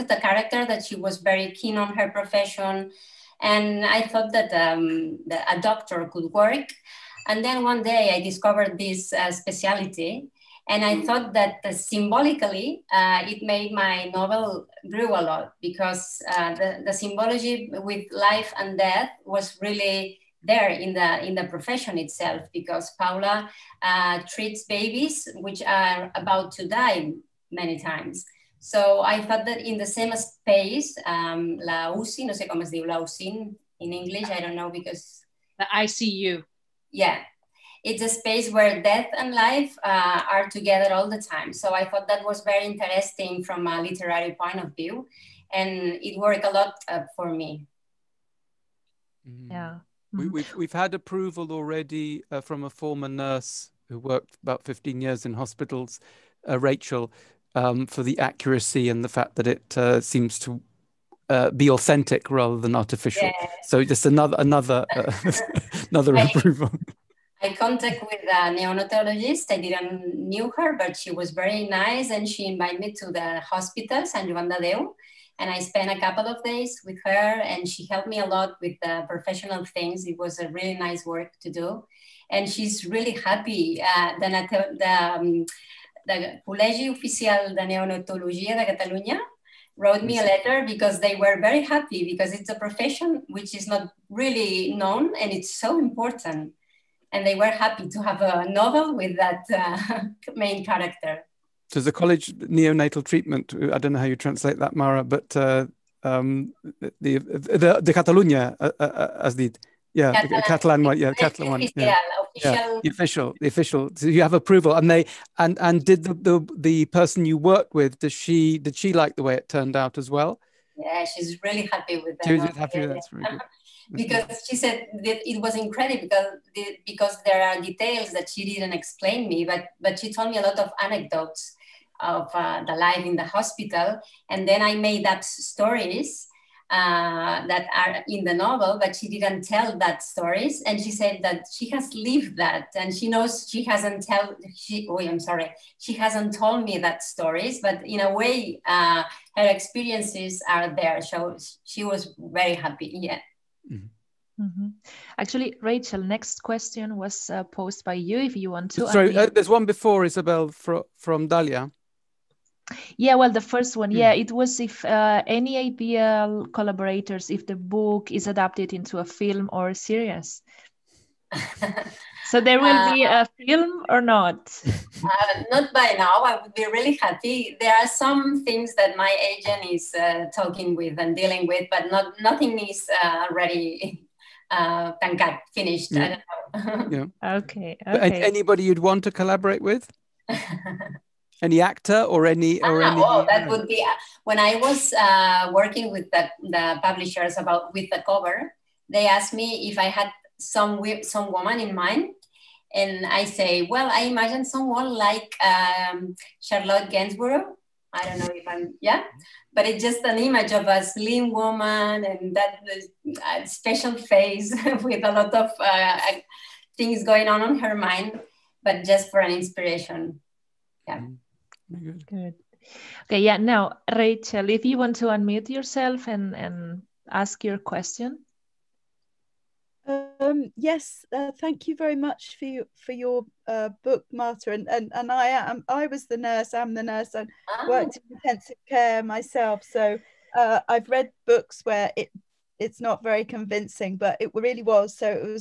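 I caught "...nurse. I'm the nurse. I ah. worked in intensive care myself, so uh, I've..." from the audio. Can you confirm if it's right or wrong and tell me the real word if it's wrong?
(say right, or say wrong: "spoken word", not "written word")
right.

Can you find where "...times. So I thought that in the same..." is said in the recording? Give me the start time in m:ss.
0:27.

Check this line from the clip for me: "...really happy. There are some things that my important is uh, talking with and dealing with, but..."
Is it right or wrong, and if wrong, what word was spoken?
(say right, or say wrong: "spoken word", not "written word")
wrong: "agent", not "important".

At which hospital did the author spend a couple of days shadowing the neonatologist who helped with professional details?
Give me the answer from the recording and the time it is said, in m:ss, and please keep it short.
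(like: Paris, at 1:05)
Sant Joan de Déu, at 1:14.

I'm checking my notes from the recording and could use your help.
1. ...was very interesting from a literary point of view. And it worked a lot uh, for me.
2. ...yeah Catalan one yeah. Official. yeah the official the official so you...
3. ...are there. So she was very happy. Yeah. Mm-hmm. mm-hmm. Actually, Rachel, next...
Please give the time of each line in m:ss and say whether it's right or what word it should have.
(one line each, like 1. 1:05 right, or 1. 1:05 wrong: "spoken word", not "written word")
1. 0:42 right
2. 1:50 right
3. 2:30 right.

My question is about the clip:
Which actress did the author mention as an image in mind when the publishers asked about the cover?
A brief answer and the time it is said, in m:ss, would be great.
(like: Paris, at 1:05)
Charlotte Gainsbourg, at 3:26.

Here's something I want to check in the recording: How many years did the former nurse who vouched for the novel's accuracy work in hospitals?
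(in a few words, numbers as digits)
15.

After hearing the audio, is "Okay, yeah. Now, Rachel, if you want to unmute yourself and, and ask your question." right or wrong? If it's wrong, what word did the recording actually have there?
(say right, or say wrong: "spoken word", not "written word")
right.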